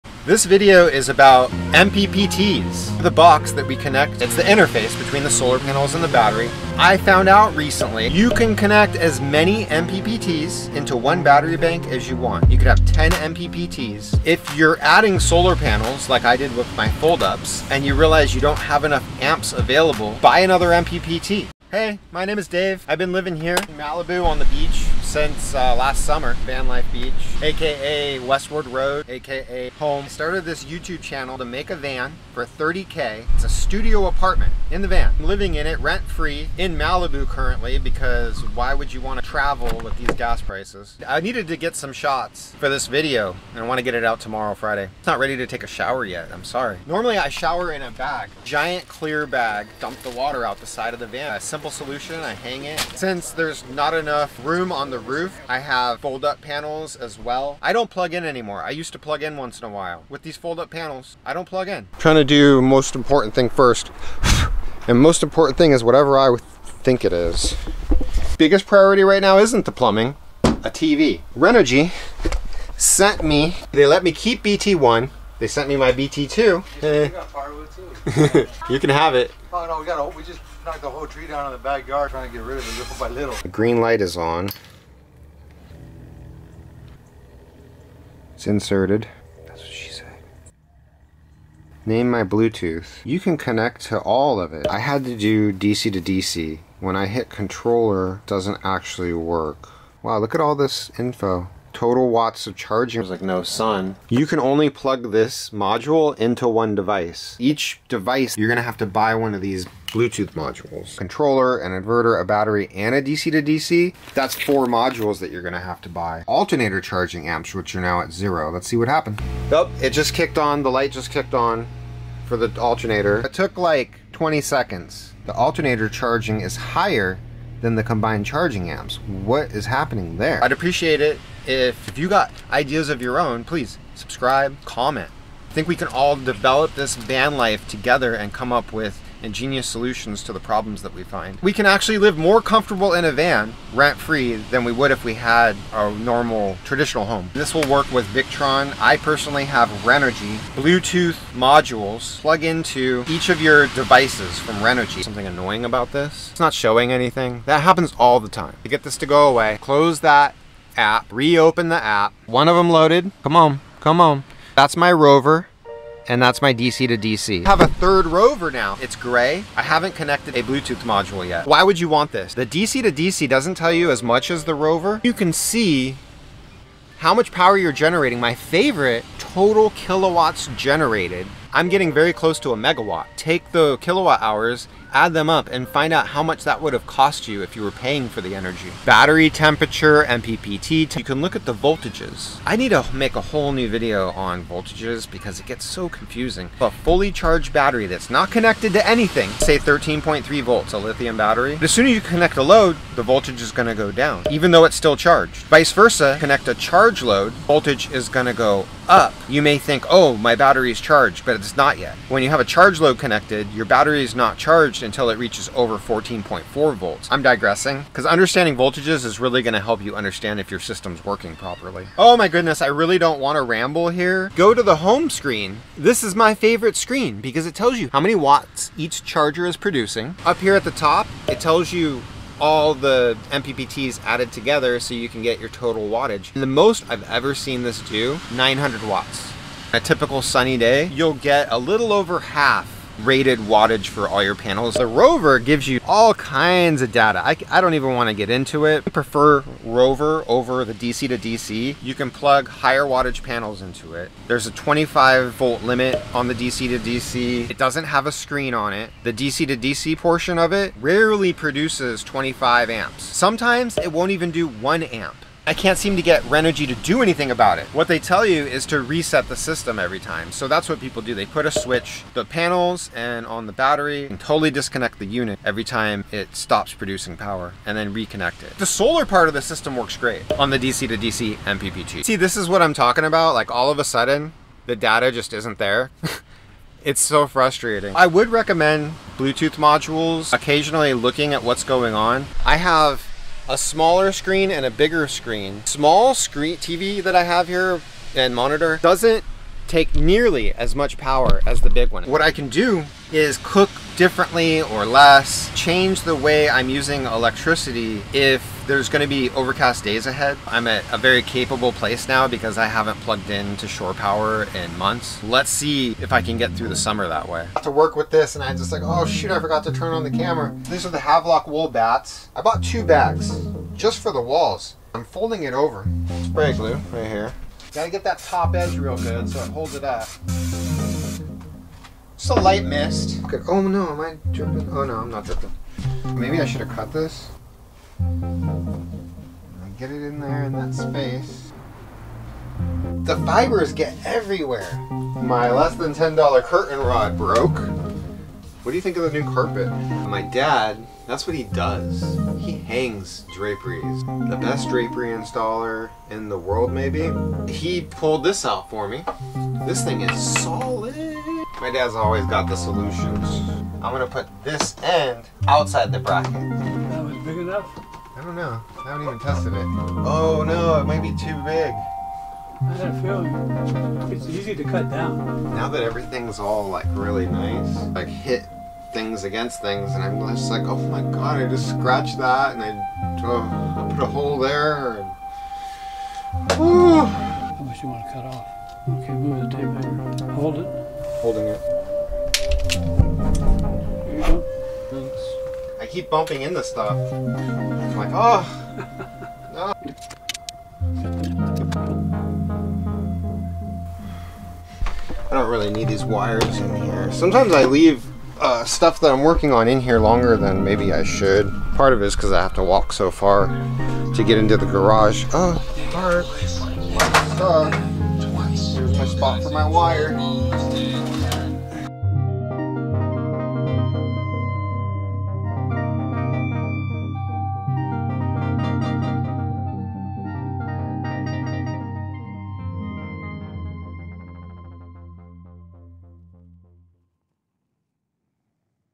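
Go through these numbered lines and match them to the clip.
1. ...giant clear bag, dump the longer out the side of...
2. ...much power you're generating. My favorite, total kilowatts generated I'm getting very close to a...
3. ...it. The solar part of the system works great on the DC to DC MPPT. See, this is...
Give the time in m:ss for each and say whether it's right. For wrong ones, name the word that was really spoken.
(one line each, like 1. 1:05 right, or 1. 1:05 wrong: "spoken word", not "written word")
1. 0:48 wrong: "water", not "longer"
2. 2:57 right
3. 4:38 right.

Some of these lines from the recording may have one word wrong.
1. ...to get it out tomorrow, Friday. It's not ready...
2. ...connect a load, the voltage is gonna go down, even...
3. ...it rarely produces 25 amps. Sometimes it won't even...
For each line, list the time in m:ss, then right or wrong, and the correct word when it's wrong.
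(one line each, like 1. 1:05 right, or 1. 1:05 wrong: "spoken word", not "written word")
1. 0:43 right
2. 3:22 right
3. 4:20 right.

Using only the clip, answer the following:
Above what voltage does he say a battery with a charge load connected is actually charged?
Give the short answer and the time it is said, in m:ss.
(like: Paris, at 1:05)
14.4 volts, at 3:35.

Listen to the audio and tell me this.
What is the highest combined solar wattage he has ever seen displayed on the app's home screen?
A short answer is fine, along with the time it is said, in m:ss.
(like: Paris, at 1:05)
900 watts, at 3:58.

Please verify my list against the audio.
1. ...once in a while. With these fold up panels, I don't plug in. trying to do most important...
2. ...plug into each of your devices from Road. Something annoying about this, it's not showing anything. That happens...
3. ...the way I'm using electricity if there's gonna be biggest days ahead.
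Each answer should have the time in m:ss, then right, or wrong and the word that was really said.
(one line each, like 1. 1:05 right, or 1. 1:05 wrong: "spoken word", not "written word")
1. 0:59 right
2. 2:32 wrong: "Renogy", not "Road"
3. 5:06 wrong: "overcast", not "biggest".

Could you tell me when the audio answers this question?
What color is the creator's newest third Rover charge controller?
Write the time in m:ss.
2:48.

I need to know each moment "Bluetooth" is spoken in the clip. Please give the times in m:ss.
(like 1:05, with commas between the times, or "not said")
1:32, 1:49, 2:30, 2:50, 4:49.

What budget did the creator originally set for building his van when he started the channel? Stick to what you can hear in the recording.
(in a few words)
$30K.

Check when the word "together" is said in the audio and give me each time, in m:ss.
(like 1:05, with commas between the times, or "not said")
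2:17, 3:54.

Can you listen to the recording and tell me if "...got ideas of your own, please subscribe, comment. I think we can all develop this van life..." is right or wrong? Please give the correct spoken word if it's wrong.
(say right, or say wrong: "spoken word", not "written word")
right.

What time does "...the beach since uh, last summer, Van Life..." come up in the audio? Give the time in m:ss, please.
0:24.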